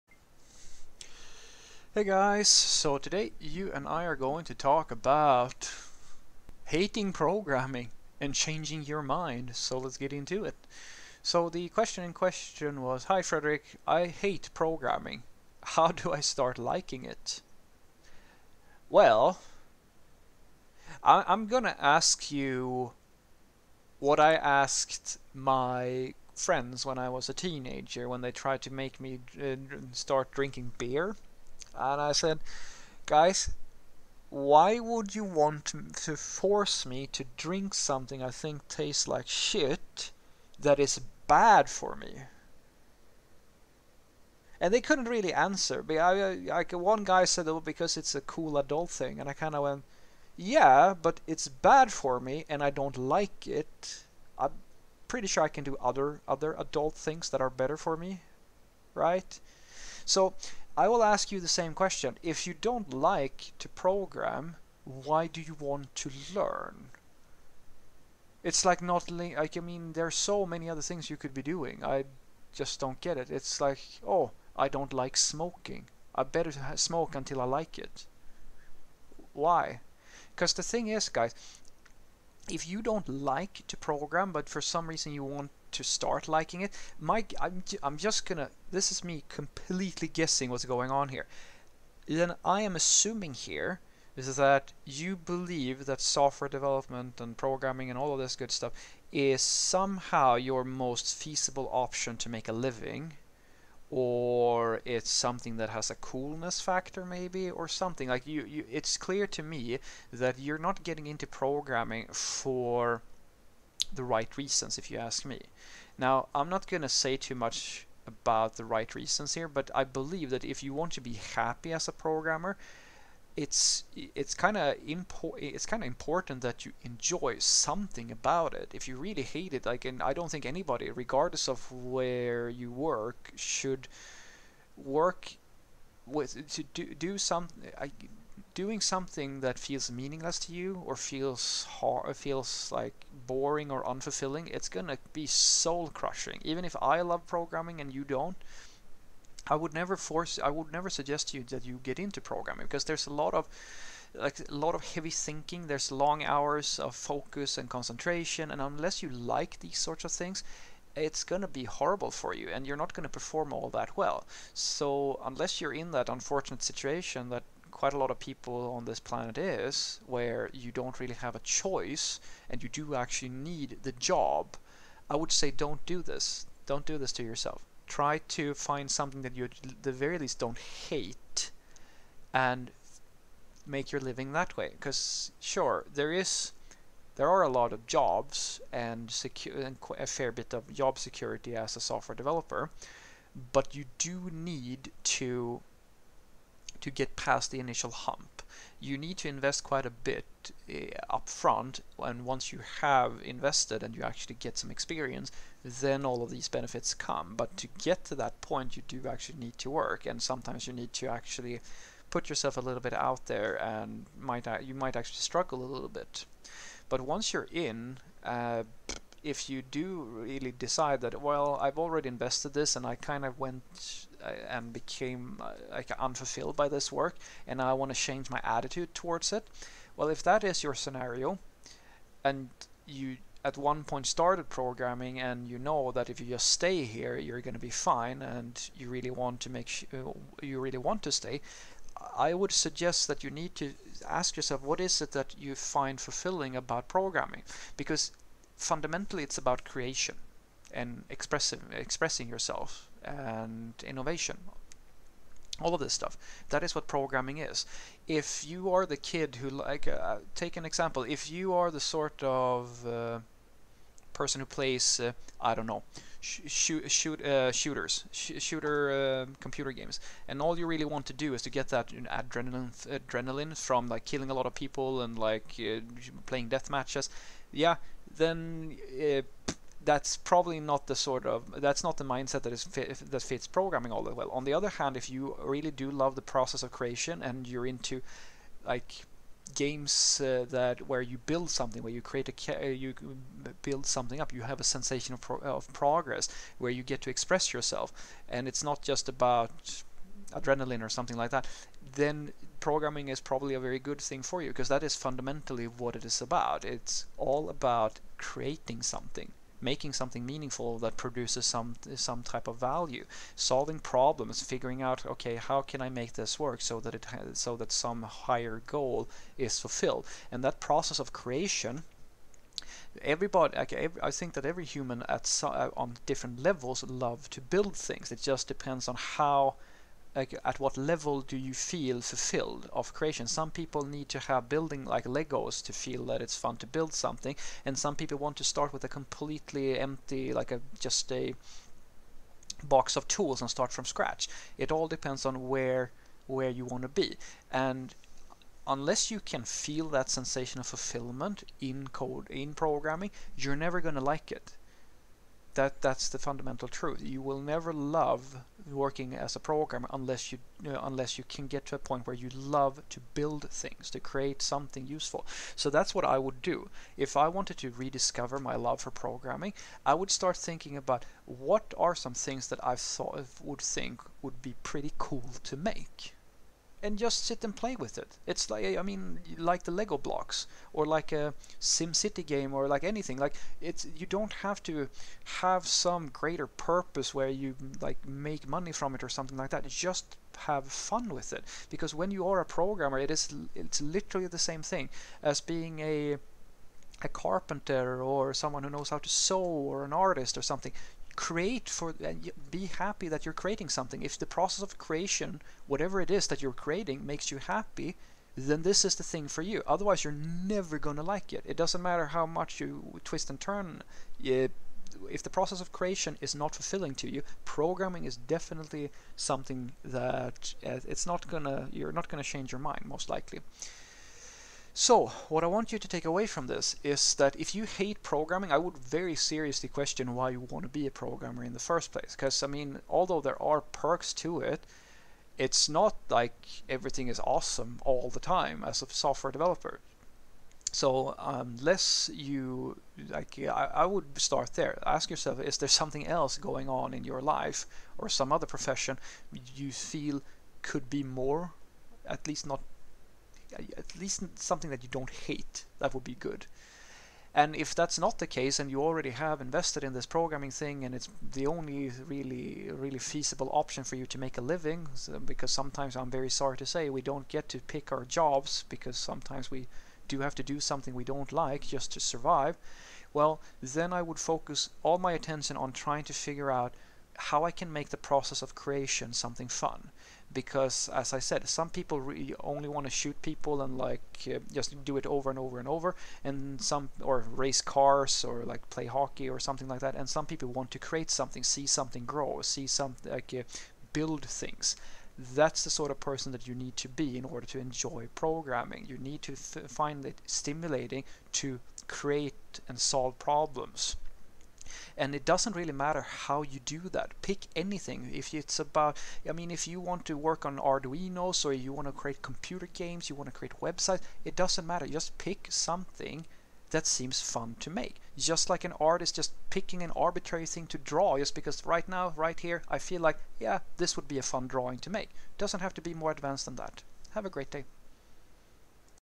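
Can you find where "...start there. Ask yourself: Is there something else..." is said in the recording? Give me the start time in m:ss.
7:24.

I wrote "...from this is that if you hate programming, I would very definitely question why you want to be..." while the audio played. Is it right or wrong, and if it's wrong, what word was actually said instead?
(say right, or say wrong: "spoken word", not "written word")
wrong: "seriously", not "definitely".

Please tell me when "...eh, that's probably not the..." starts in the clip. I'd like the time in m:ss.
4:38.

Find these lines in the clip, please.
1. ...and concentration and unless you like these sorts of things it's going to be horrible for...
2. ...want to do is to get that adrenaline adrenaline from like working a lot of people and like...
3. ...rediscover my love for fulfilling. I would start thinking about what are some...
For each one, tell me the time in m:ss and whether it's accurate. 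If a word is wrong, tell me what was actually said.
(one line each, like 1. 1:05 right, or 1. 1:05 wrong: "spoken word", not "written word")
1. 2:37 right
2. 4:30 wrong: "killing", not "working"
3. 6:07 wrong: "programming", not "fulfilling".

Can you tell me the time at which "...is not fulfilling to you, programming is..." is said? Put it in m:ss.
6:56.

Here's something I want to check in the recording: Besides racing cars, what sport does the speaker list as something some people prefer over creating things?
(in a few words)
hockey.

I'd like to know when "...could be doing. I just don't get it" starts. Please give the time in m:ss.
1:11.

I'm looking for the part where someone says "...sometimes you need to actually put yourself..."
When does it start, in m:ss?
3:30.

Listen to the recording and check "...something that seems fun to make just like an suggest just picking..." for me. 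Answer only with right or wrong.
wrong.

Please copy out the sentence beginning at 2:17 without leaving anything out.
I, doing something that feels meaningless to you or feels hard, feels like boring or unfulfilling, it's gonna be soul crushing.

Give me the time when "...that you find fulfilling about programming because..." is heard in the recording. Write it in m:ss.
4:05.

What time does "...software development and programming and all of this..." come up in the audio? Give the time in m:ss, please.
1:36.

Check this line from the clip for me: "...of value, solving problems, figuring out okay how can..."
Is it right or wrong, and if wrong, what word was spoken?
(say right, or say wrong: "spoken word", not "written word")
right.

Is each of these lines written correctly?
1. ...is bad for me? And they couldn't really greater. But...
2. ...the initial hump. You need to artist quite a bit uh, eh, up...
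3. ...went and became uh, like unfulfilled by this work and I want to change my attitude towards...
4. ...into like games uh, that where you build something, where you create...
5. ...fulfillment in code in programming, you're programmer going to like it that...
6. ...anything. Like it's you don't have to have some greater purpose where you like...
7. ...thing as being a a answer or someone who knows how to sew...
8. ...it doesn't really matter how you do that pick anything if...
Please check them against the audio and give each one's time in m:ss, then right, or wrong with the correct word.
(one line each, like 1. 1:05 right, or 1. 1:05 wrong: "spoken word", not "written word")
1. 0:40 wrong: "answer", not "greater"
2. 3:17 wrong: "invest", not "artist"
3. 3:43 right
4. 4:47 right
5. 5:50 wrong: "never", not "programmer"
6. 6:22 right
7. 6:34 wrong: "carpenter", not "answer"
8. 8:25 right.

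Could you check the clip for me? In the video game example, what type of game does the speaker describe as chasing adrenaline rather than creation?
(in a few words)
shooters.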